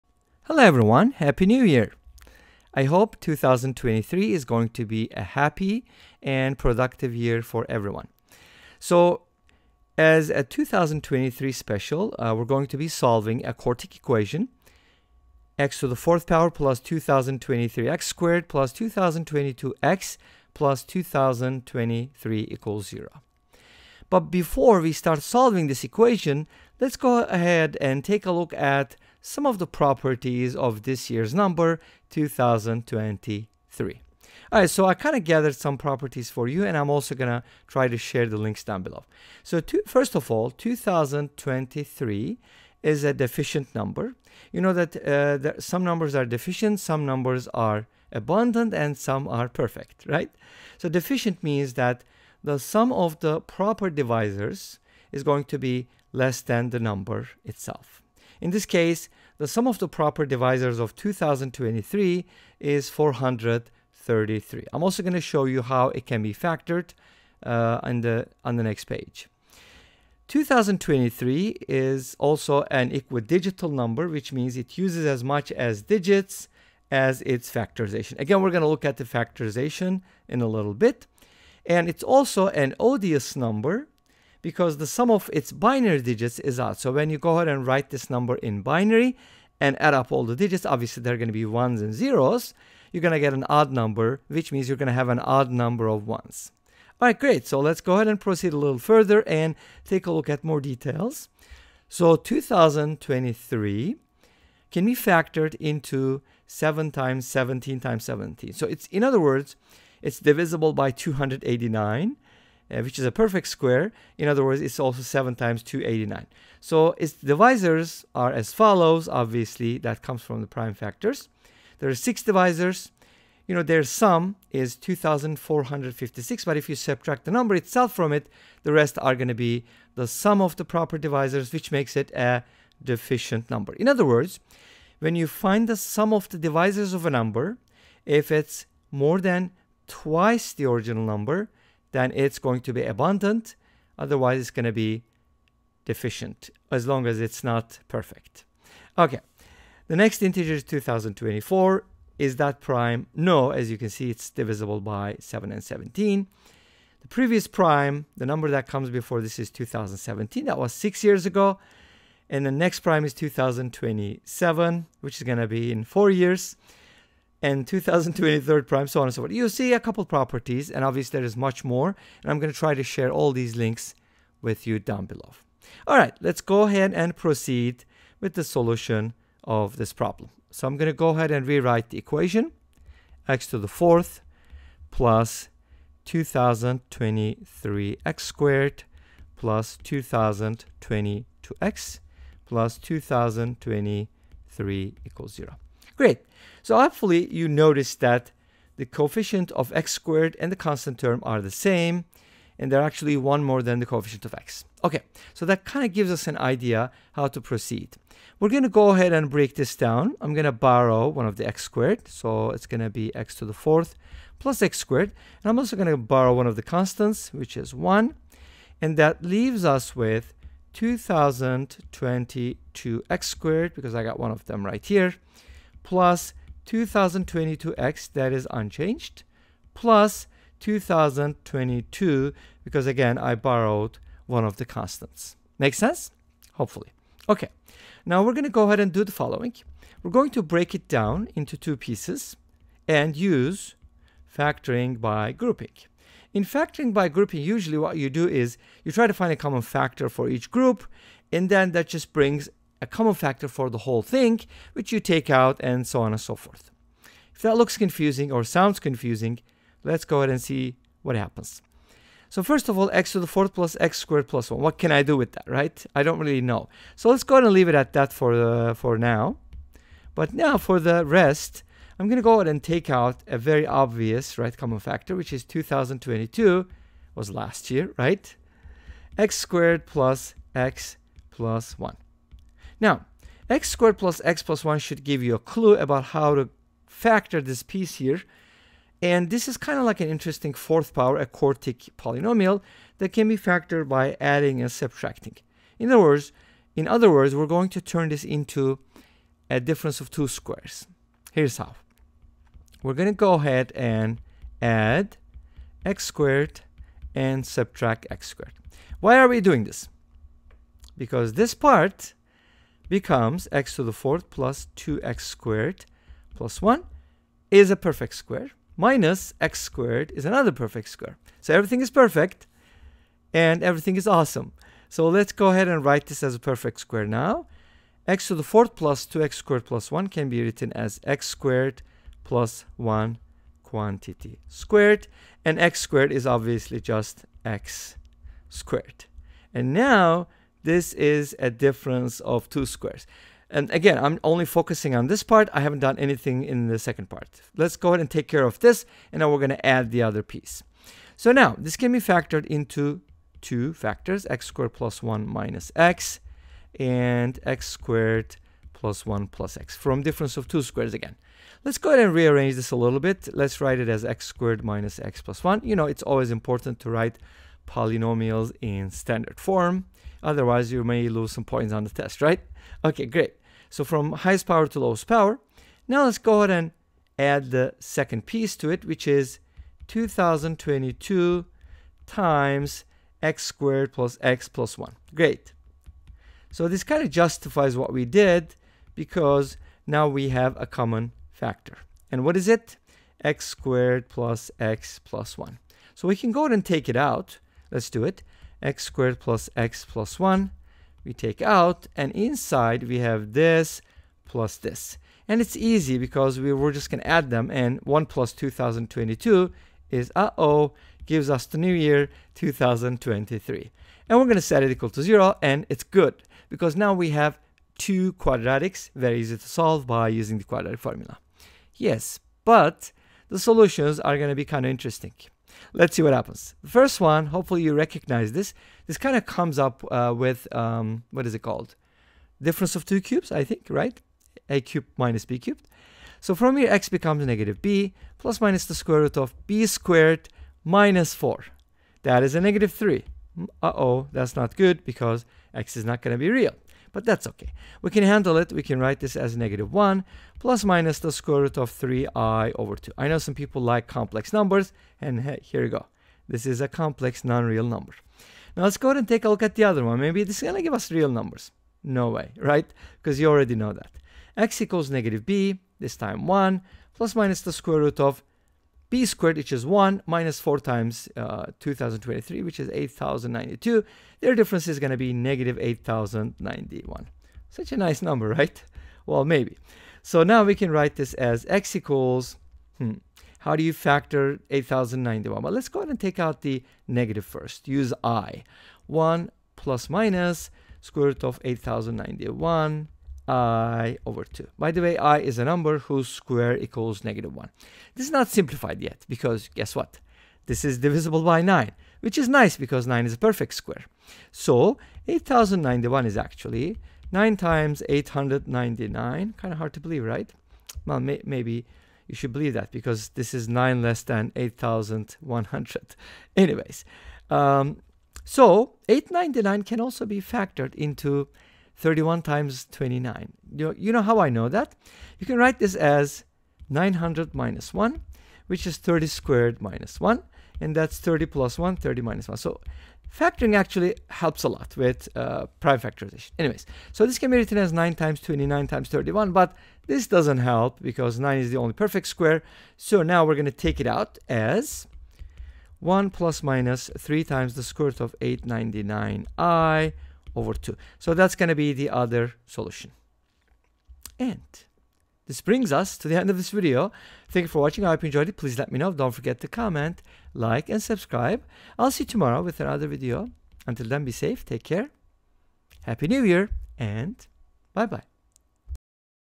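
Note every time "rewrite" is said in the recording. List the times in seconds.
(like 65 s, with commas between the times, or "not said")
181 s.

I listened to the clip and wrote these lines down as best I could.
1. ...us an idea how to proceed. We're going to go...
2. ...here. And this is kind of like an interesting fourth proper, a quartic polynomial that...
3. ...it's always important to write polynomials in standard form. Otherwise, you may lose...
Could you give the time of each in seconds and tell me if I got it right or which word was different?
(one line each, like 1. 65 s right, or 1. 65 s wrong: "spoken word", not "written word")
1. 206 s right
2. 287 s wrong: "power", not "proper"
3. 365 s right.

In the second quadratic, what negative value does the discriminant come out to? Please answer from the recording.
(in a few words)
-8,091.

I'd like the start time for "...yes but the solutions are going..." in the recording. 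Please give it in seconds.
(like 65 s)
421 s.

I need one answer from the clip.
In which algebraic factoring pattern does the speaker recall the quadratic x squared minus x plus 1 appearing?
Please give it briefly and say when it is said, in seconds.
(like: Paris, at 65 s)
Difference of two cubes, at 432 s.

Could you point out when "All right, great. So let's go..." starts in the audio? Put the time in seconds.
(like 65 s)
96 s.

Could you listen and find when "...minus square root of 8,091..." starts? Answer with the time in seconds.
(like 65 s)
489 s.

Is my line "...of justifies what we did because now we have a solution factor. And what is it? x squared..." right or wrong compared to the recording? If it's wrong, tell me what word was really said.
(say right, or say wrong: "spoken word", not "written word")
wrong: "common", not "solution".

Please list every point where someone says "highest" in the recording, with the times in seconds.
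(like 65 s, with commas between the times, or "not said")
374 s.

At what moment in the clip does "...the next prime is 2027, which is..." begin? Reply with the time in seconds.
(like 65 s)
162 s.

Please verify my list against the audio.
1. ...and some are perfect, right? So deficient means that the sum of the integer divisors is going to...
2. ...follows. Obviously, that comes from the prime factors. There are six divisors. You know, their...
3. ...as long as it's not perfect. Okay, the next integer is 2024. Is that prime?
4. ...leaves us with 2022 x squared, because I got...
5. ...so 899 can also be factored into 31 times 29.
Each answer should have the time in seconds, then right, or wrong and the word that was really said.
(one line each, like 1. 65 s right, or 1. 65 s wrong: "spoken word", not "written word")
1. 48 s wrong: "proper", not "integer"
2. 118 s right
3. 146 s right
4. 219 s right
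5. 518 s right.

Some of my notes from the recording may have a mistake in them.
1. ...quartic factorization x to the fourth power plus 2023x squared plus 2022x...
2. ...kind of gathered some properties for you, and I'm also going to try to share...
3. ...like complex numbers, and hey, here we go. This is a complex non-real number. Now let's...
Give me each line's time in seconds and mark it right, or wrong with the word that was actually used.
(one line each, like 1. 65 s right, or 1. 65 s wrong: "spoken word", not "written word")
1. 13 s wrong: "equation", not "factorization"
2. 34 s right
3. 453 s right.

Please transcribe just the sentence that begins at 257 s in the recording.
If that looks confusing or sounds confusing, let's go ahead and see what happens.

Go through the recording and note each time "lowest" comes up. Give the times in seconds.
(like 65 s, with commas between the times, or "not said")
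374 s.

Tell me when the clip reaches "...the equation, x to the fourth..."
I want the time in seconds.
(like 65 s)
181 s.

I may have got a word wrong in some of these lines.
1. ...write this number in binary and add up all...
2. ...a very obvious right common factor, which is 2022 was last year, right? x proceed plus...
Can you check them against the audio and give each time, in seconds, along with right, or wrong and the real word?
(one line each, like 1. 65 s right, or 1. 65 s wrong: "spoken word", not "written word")
1. 87 s right
2. 273 s wrong: "squared", not "proceed".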